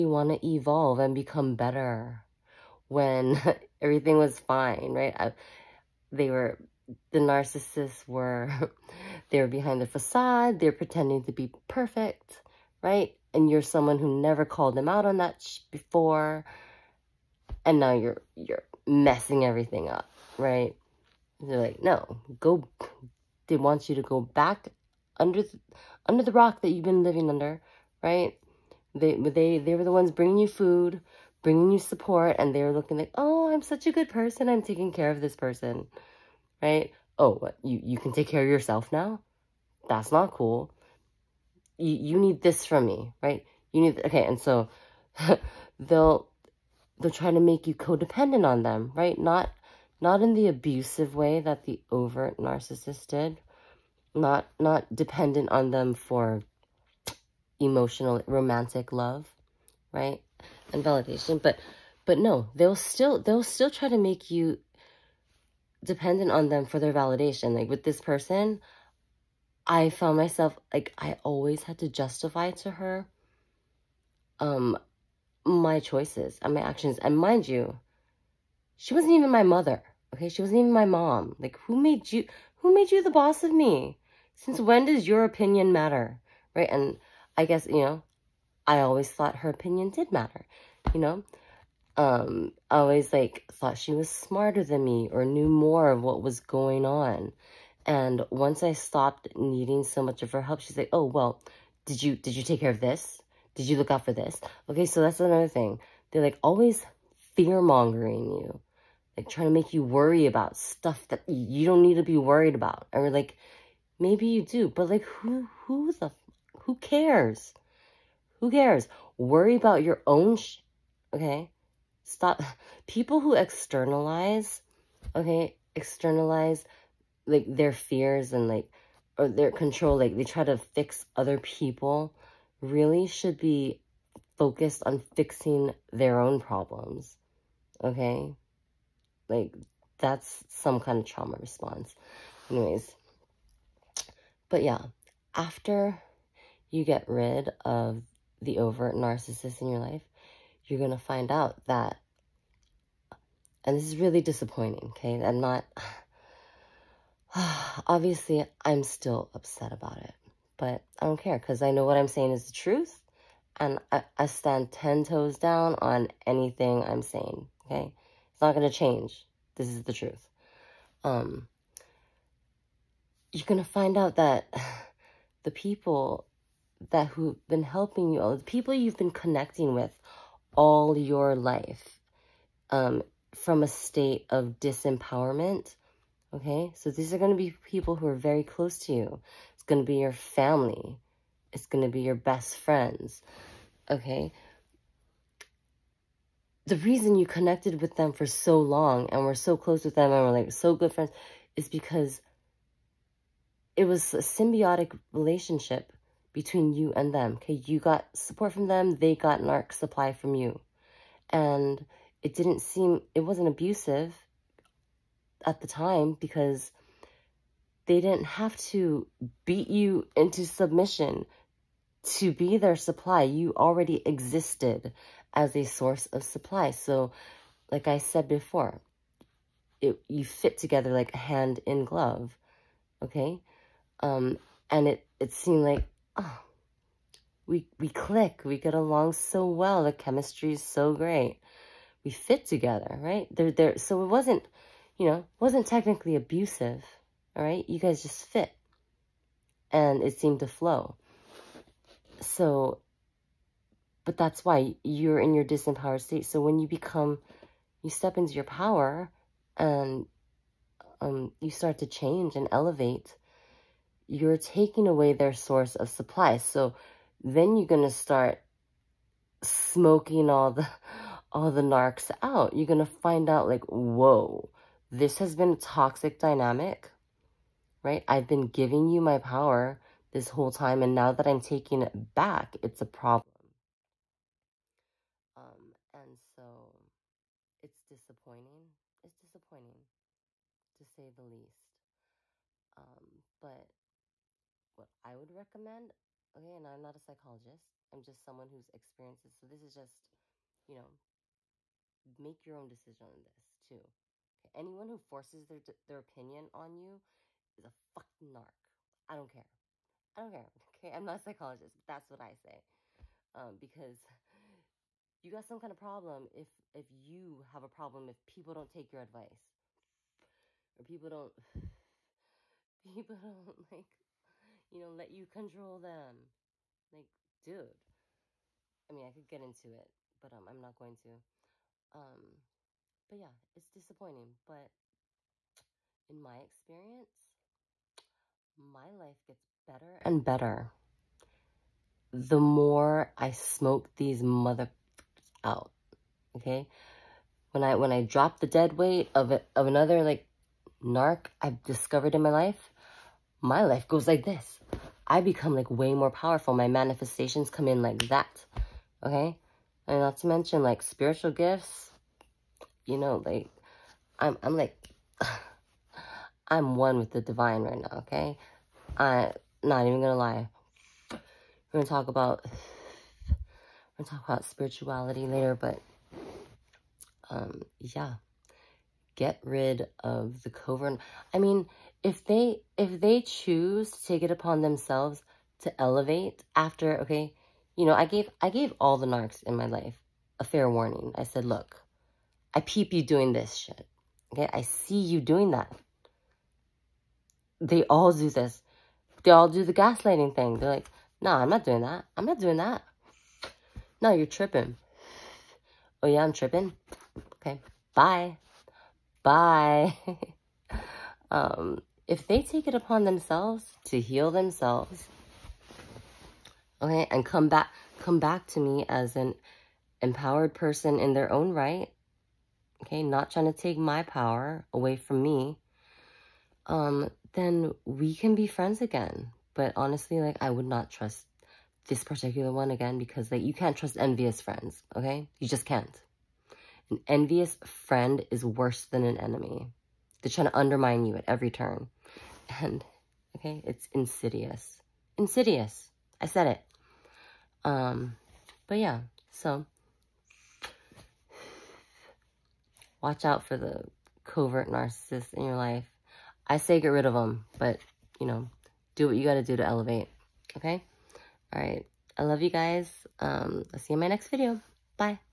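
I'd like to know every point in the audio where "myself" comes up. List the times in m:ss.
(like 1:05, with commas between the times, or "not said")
1:10.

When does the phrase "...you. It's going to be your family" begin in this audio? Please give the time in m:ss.
3:08.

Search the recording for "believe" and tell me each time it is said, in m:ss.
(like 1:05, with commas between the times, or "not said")
not said.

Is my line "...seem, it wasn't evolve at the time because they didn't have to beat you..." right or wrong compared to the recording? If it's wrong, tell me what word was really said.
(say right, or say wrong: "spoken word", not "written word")
wrong: "abusive", not "evolve".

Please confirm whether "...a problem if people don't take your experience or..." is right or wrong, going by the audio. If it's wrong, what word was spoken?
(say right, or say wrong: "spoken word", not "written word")
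wrong: "advice", not "experience".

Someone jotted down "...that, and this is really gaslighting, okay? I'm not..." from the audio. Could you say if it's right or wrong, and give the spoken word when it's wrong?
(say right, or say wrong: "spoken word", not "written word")
wrong: "disappointing", not "gaslighting".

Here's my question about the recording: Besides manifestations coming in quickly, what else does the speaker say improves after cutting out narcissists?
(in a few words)
Spiritual gifts.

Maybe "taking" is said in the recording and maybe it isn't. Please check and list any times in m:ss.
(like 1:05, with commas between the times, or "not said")
0:34, 4:24, 4:41.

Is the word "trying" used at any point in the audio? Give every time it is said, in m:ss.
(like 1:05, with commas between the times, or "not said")
0:47, 1:49, 7:03, 7:20.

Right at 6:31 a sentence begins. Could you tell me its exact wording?
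I said, look, I peep you doing this shit.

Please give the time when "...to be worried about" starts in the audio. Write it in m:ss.
1:51.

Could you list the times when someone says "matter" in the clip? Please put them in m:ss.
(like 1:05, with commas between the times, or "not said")
1:25, 1:30.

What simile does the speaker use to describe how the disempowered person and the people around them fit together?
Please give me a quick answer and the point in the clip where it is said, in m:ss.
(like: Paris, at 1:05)
Hand in glove, at 3:51.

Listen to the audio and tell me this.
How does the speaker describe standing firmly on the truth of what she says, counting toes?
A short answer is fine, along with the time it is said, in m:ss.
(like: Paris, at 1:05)
10, at 2:44.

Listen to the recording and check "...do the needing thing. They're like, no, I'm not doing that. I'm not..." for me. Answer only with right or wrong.
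wrong.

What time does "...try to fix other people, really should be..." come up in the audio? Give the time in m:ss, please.
2:10.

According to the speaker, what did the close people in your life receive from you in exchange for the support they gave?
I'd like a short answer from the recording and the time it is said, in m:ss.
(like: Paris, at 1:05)
Narc supply, at 3:29.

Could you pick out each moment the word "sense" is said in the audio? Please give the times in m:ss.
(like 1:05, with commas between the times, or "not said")
not said.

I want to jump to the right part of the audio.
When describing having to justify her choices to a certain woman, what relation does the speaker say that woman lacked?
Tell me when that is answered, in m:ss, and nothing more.
1:19.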